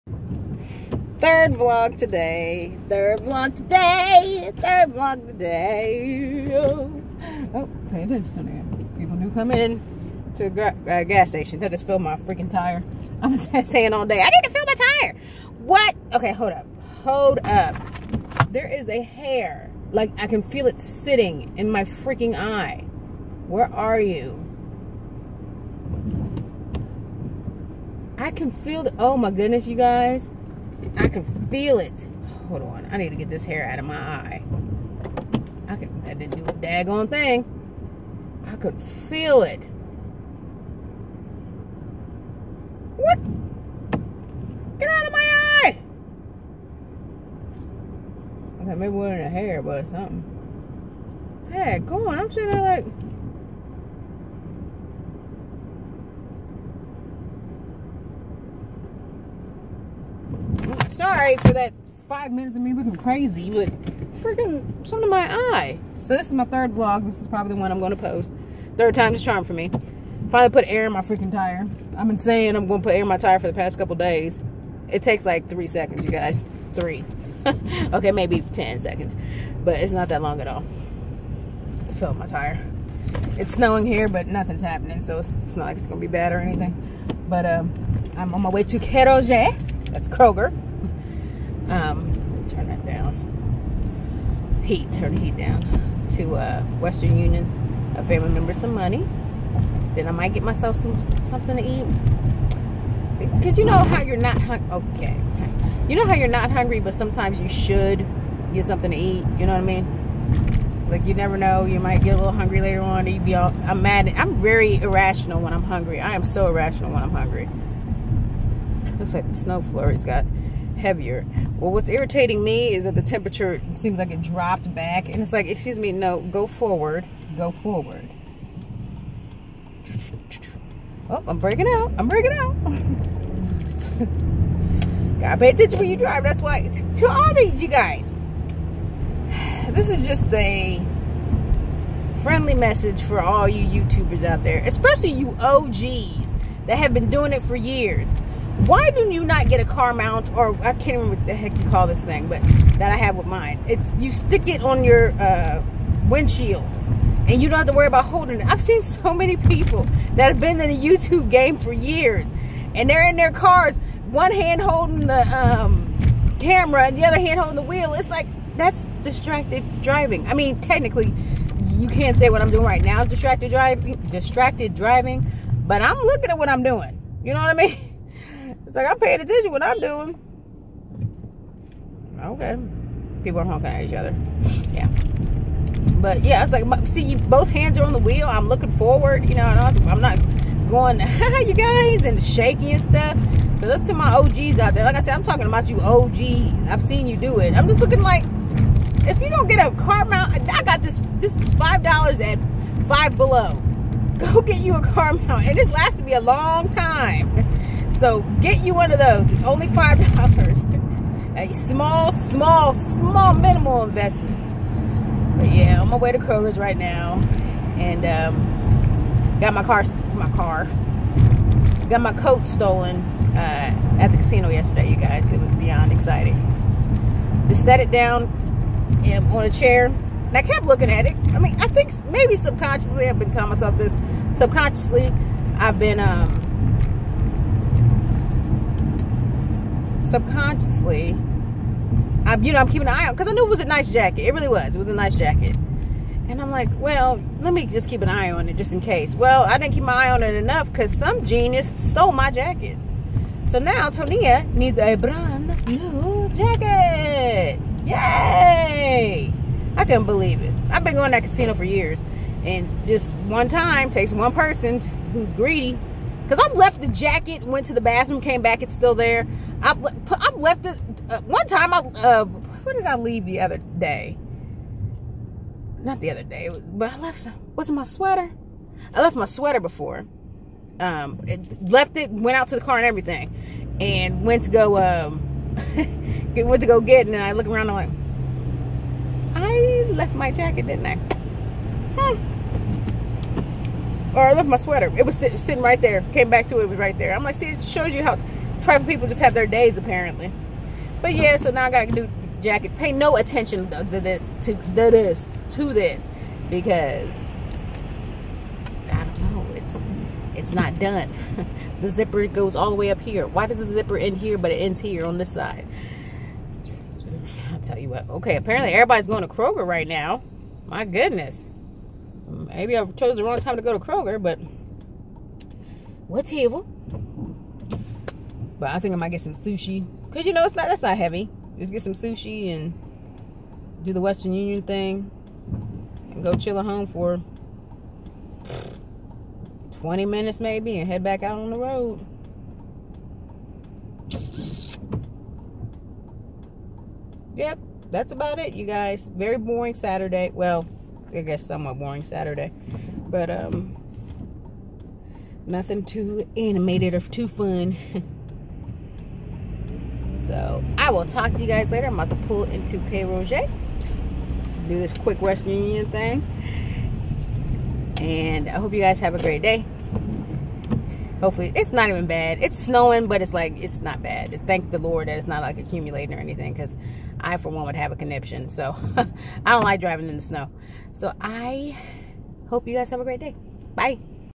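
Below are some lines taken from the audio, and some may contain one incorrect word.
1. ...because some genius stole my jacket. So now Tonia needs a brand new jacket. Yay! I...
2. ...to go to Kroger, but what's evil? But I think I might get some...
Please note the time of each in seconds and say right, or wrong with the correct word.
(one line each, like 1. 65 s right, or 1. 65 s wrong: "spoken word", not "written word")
1. 250 s right
2. 323 s right.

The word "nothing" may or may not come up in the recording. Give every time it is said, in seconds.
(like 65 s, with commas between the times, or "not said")
84 s, 355 s.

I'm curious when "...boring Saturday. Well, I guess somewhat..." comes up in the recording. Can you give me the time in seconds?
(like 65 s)
349 s.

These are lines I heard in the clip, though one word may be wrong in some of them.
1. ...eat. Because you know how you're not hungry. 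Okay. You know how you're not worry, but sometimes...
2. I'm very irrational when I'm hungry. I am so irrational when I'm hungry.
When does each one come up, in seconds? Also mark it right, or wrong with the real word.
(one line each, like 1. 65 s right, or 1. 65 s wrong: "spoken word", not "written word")
1. 101 s wrong: "hungry", not "worry"
2. 114 s right.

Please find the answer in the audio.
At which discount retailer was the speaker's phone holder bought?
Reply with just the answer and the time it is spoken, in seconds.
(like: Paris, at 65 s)
Five Below, at 202 s.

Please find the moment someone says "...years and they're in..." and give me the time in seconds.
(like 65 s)
161 s.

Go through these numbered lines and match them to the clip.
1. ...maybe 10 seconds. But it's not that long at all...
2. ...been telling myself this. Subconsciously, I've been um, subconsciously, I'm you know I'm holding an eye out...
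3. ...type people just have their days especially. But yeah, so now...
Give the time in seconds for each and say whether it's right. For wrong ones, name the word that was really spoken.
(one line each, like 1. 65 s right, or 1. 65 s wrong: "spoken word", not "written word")
1. 78 s right
2. 233 s wrong: "keeping", not "holding"
3. 298 s wrong: "apparently", not "especially".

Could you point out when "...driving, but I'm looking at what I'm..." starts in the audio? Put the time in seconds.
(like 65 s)
174 s.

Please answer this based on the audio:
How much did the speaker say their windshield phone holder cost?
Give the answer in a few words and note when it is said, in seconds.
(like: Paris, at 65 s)
$5, at 201 s.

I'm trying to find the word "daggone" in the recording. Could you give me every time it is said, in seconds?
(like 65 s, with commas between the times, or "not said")
36 s.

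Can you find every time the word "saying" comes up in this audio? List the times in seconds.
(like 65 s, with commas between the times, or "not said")
13 s, 72 s.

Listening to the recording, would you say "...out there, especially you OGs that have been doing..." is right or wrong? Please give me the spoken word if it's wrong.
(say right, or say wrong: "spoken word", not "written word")
right.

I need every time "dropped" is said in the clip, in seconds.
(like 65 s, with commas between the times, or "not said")
124 s.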